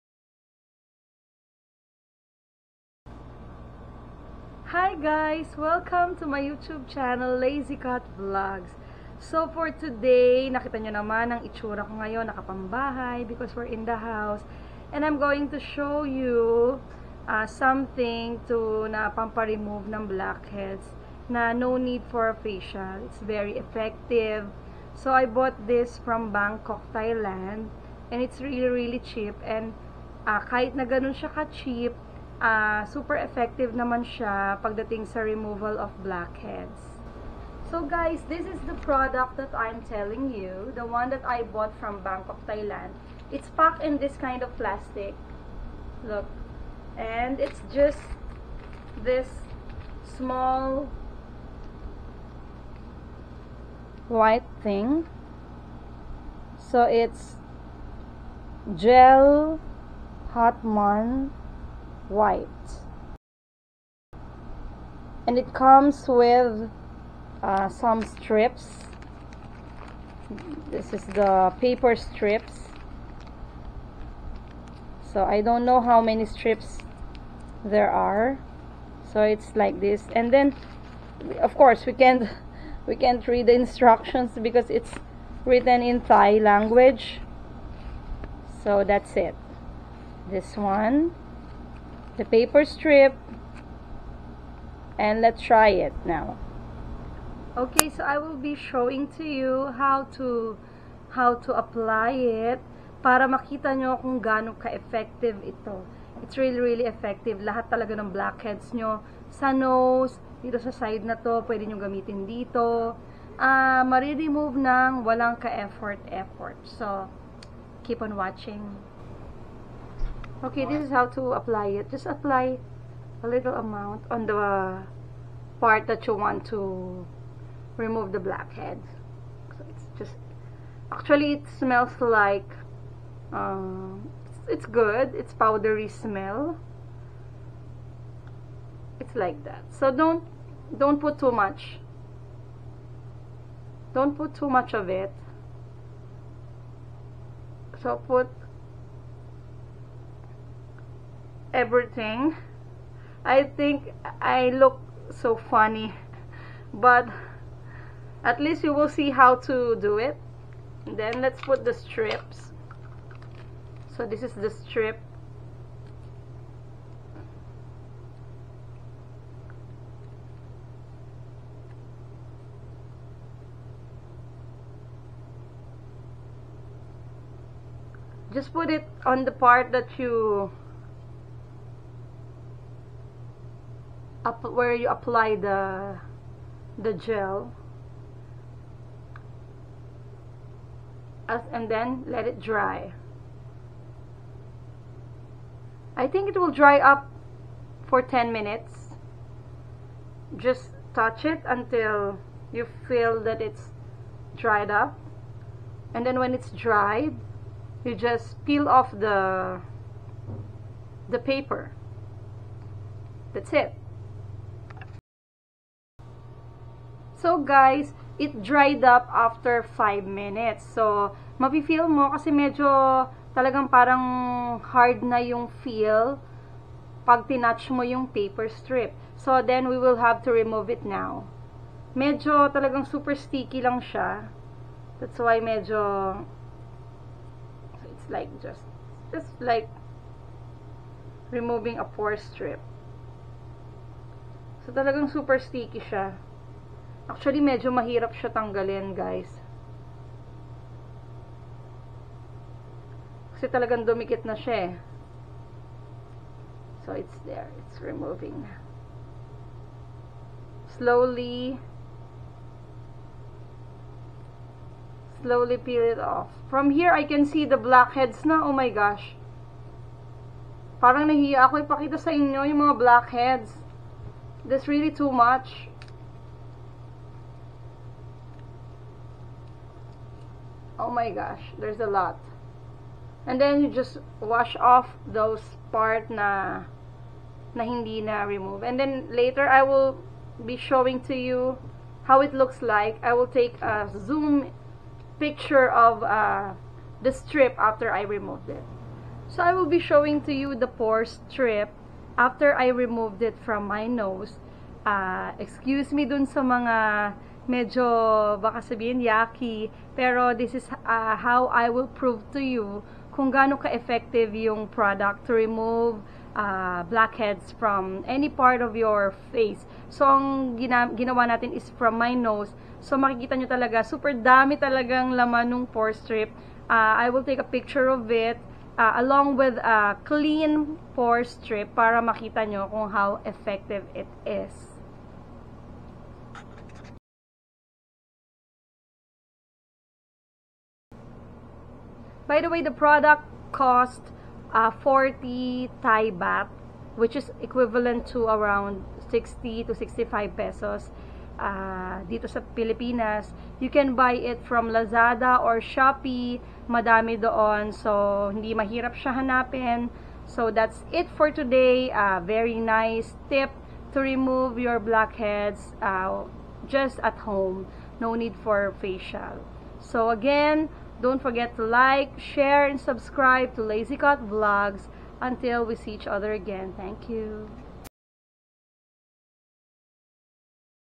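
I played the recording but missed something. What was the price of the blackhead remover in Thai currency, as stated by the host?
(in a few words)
40 Thai baht.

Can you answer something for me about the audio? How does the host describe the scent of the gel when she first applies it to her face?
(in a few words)
powdery.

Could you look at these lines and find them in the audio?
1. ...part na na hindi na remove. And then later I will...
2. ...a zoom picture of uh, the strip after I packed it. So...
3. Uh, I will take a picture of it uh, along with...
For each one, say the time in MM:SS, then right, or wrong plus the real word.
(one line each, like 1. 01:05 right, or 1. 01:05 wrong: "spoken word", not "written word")
1. 04:45 right
2. 04:53 wrong: "removed", not "packed"
3. 05:26 right.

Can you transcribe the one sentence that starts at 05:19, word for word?
So, ang gina ginawa natin is from my nose.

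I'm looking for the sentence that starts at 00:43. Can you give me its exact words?
It's packed in this kind of plastic.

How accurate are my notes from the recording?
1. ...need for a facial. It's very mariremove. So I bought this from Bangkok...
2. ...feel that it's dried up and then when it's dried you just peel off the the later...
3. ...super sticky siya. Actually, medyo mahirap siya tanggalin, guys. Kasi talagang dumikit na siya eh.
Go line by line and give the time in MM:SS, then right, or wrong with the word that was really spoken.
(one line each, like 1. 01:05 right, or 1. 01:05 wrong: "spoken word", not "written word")
1. 00:21 wrong: "effective", not "mariremove"
2. 03:22 wrong: "paper", not "later"
3. 04:05 right.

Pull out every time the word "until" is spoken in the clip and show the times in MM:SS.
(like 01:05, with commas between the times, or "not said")
03:21, 06:15.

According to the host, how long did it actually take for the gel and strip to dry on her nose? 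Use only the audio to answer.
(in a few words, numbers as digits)
5 minutes.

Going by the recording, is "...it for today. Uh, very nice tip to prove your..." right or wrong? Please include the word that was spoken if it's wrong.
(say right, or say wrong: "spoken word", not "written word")
wrong: "remove", not "prove".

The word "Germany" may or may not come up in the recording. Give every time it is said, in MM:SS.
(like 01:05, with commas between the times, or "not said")
not said.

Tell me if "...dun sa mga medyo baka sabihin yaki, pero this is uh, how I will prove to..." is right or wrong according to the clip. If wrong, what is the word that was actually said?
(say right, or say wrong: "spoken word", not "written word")
right.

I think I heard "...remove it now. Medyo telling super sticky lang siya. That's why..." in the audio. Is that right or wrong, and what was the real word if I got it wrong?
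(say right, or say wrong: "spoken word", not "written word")
wrong: "talagang", not "telling".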